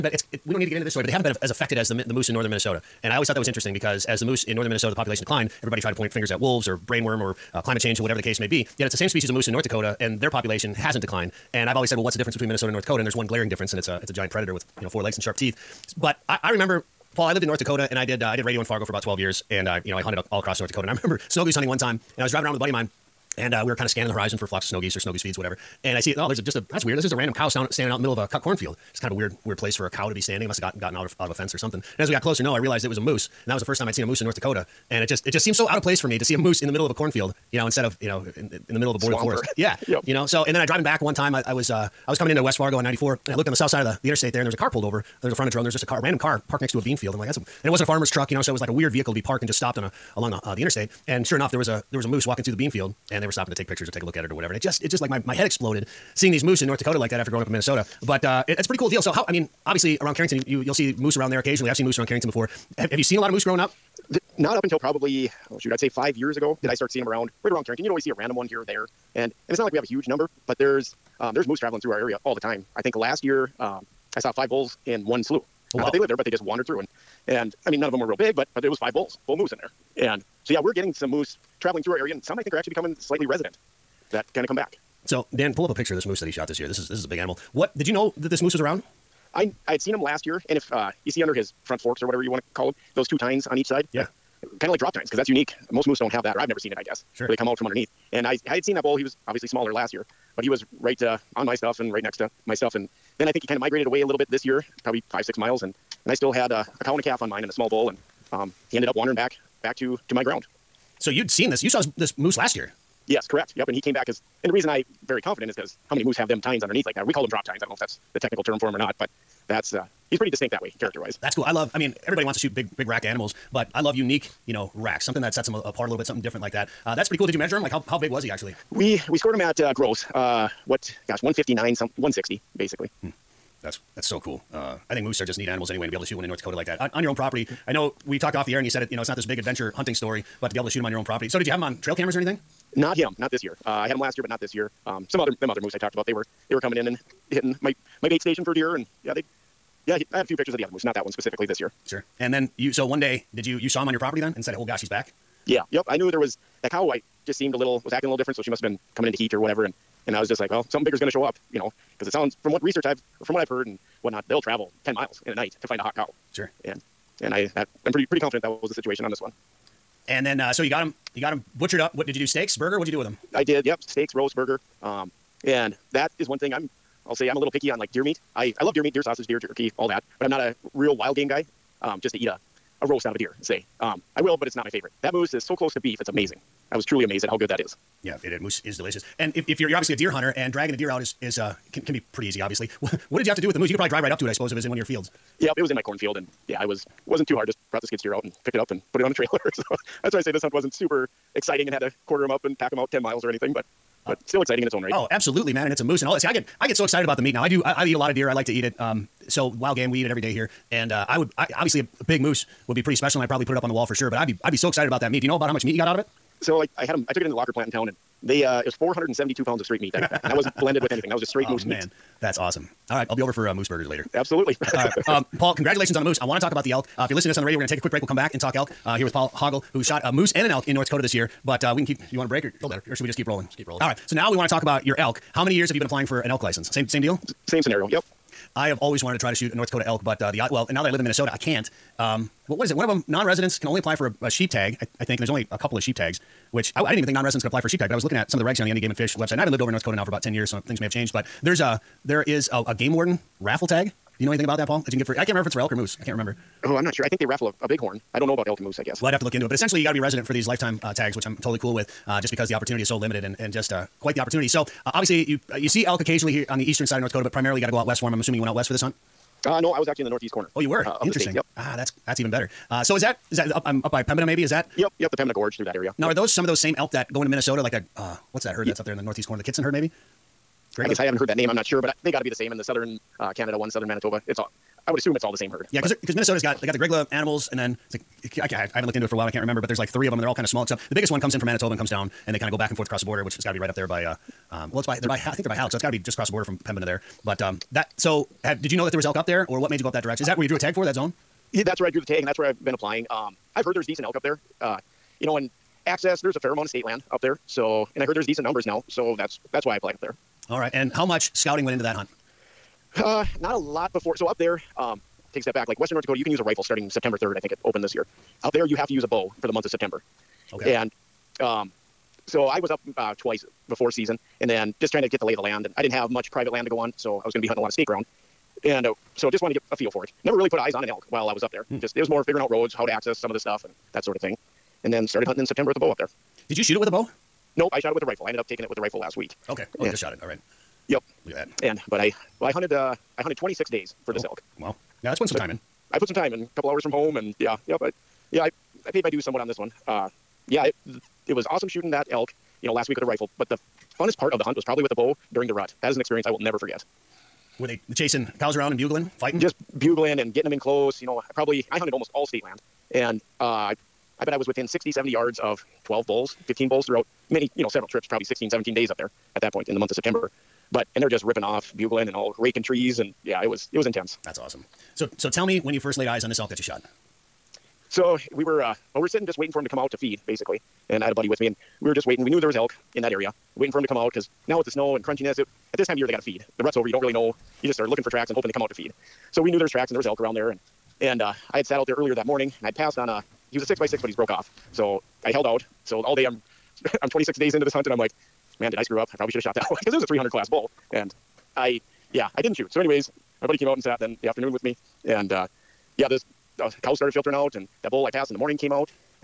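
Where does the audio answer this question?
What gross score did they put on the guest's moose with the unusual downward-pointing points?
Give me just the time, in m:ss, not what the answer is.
2:11.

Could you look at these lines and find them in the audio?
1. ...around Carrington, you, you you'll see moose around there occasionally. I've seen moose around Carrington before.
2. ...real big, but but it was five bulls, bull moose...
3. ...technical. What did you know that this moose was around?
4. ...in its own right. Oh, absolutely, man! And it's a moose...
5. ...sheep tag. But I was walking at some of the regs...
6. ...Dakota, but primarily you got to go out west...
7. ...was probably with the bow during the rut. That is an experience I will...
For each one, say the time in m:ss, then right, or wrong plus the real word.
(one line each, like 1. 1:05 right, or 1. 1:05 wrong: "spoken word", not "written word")
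1. 1:00 right
2. 1:18 right
3. 1:27 wrong: "animal", not "technical"
4. 3:24 right
5. 4:07 wrong: "looking", not "walking"
6. 4:27 right
7. 5:54 right.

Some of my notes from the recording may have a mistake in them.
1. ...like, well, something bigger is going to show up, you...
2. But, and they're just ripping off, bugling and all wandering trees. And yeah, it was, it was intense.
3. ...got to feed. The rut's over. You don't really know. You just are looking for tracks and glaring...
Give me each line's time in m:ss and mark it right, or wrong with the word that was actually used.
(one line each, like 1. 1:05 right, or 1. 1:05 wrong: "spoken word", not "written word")
1. 2:40 right
2. 6:10 wrong: "raking", not "wandering"
3. 6:26 wrong: "hoping", not "glaring".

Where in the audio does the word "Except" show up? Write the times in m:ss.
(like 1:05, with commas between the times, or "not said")
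4:50.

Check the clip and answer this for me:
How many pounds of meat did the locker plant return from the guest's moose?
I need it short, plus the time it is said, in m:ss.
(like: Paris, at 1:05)
472, at 3:38.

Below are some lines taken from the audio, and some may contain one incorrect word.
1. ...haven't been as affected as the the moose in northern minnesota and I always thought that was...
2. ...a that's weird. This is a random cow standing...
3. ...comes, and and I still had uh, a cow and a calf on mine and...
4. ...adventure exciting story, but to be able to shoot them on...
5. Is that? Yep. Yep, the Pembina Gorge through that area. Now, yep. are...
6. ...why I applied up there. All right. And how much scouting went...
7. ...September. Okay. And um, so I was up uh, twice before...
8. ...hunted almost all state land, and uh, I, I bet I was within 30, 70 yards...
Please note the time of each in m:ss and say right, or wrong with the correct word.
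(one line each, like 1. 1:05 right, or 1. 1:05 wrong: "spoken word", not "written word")
1. 0:01 right
2. 0:26 right
3. 1:45 wrong: "miles", not "comes"
4. 2:19 wrong: "hunting", not "exciting"
5. 4:34 right
6. 5:09 right
7. 5:19 right
8. 6:01 wrong: "60", not "30".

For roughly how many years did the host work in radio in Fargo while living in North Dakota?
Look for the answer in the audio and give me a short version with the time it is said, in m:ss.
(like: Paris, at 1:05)
12, at 0:19.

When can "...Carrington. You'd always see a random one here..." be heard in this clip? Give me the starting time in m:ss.
1:07.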